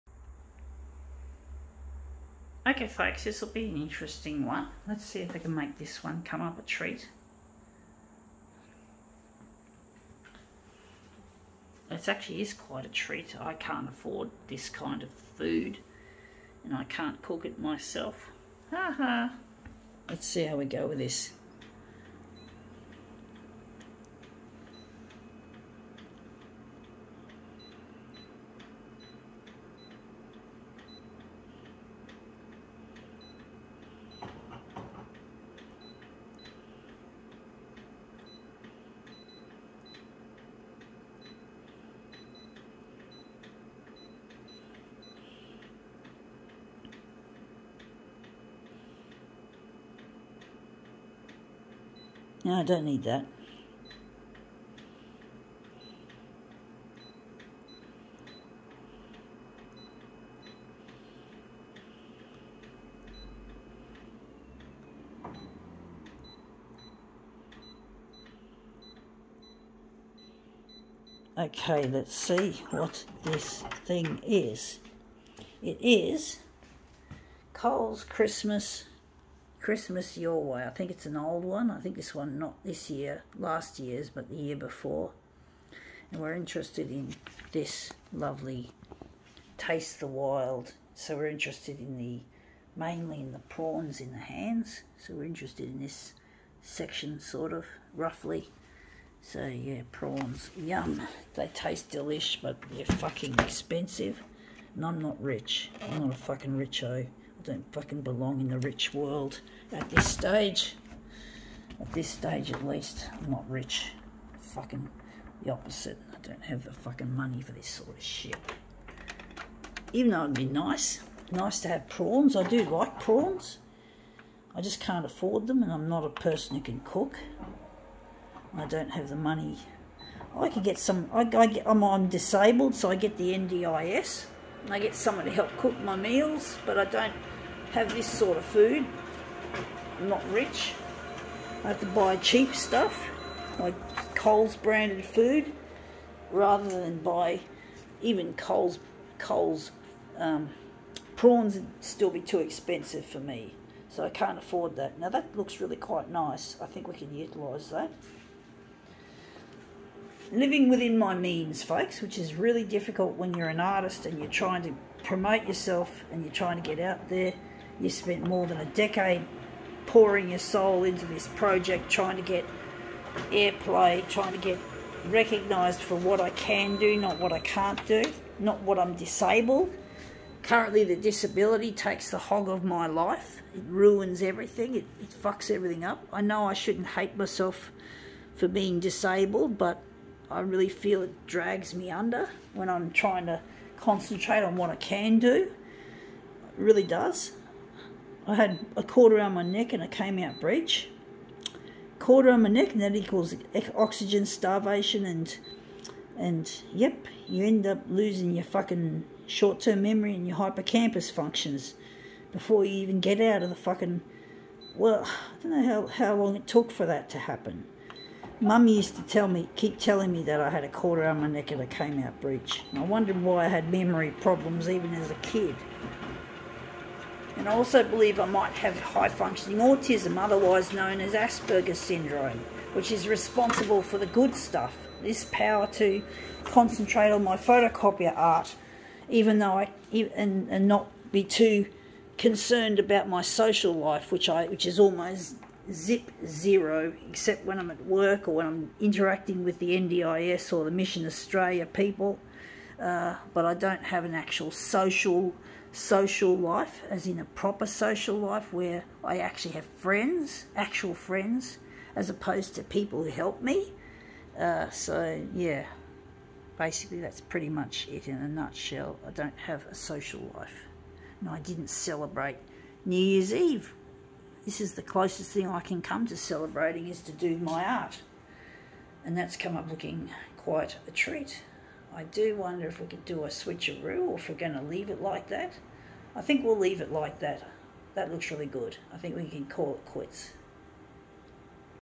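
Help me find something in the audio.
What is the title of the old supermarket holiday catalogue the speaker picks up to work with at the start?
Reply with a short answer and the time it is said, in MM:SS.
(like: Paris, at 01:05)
Christmas Your Way, at 01:19.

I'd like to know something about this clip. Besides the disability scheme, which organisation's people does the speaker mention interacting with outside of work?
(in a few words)
Mission Australia.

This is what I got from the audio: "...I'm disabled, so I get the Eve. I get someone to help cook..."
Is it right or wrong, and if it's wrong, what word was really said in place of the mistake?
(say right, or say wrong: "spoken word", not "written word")
wrong: "NDIS", not "Eve".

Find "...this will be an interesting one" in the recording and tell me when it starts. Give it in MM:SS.
00:03.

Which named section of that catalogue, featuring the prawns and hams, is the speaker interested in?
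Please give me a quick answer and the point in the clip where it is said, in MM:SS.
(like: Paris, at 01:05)
Taste the Wild, at 01:29.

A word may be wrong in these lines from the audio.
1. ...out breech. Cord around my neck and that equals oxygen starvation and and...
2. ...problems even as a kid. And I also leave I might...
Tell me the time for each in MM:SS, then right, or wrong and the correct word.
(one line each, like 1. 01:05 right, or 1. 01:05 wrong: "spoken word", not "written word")
1. 03:20 right
2. 03:44 wrong: "believe", not "leave".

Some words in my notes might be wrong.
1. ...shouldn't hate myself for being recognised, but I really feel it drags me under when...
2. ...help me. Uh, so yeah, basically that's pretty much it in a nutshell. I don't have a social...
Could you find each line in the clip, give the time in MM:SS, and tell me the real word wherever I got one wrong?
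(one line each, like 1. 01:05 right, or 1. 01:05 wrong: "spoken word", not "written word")
1. 03:06 wrong: "disabled", not "recognised"
2. 04:23 right.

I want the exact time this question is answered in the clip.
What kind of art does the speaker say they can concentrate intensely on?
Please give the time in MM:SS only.
03:57.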